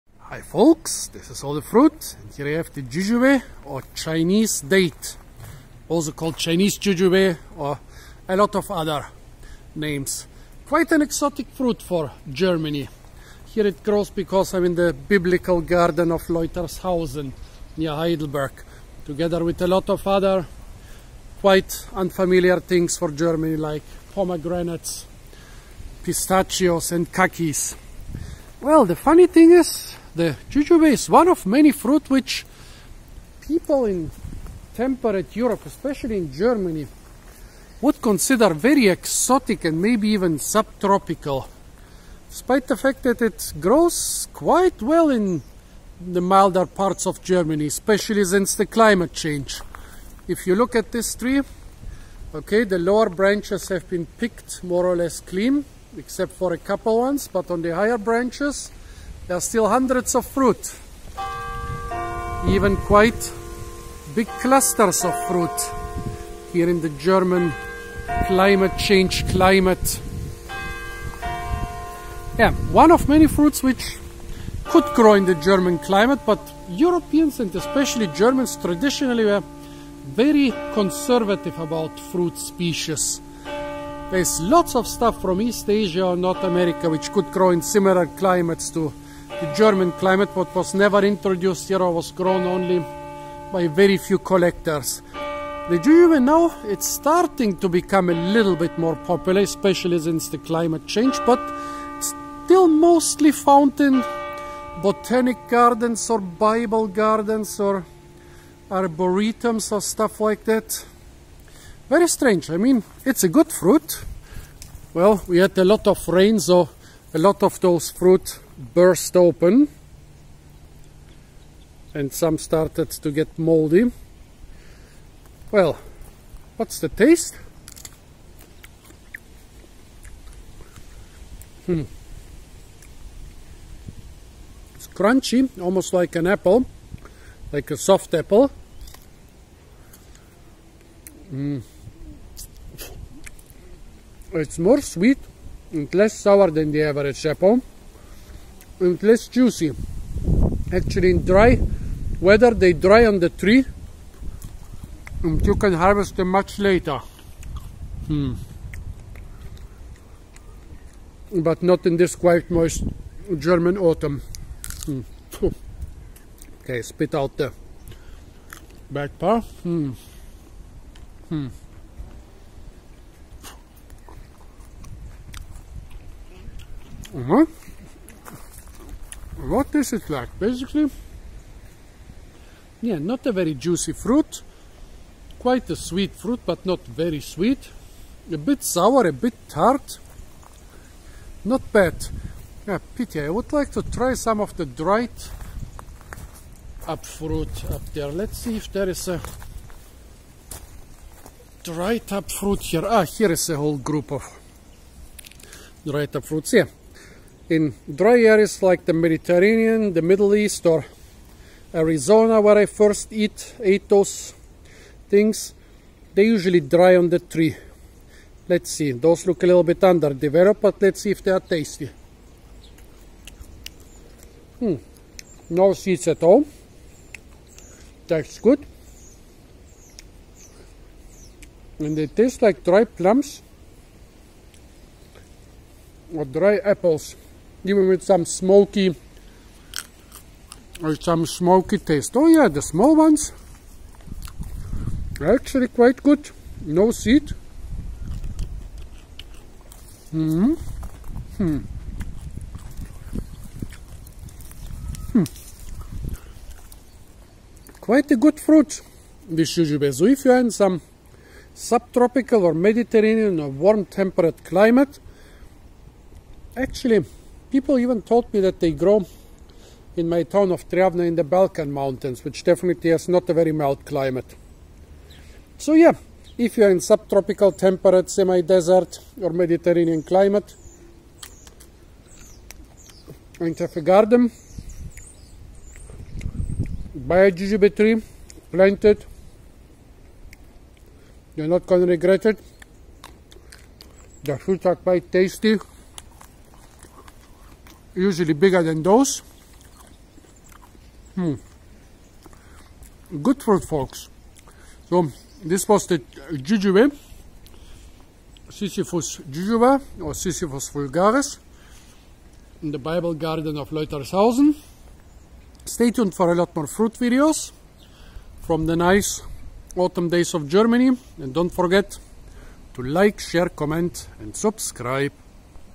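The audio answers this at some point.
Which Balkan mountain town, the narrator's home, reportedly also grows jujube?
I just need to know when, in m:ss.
4:30.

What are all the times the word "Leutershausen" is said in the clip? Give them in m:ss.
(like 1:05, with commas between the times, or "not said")
0:16, 5:13.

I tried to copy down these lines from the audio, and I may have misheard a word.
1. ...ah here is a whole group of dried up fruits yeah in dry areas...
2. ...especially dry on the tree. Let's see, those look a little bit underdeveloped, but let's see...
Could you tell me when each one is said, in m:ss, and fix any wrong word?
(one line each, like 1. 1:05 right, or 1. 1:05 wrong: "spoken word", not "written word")
1. 3:22 right
2. 3:36 wrong: "usually", not "especially".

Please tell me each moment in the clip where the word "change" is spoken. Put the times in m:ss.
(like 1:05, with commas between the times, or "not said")
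0:49, 1:08, 1:40.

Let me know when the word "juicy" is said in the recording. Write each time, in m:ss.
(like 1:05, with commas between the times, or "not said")
2:29, 3:03.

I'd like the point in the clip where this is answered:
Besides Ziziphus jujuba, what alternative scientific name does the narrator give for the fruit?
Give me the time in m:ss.
5:10.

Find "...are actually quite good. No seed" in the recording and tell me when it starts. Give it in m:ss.
4:05.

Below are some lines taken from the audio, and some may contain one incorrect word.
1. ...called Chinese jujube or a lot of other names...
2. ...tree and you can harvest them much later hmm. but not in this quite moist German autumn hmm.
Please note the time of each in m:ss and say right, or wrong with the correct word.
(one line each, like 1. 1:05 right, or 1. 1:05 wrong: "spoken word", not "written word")
1. 0:06 right
2. 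2:33 right.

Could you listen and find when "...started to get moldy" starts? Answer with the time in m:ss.
2:02.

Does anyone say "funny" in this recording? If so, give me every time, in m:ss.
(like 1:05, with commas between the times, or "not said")
0:28.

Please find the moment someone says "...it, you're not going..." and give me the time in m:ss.
4:48.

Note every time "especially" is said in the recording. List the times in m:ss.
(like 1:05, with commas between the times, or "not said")
0:35, 0:47, 1:17, 1:39.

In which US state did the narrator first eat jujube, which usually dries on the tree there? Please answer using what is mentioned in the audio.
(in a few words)
Arizona.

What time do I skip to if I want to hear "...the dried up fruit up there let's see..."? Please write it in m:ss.
3:14.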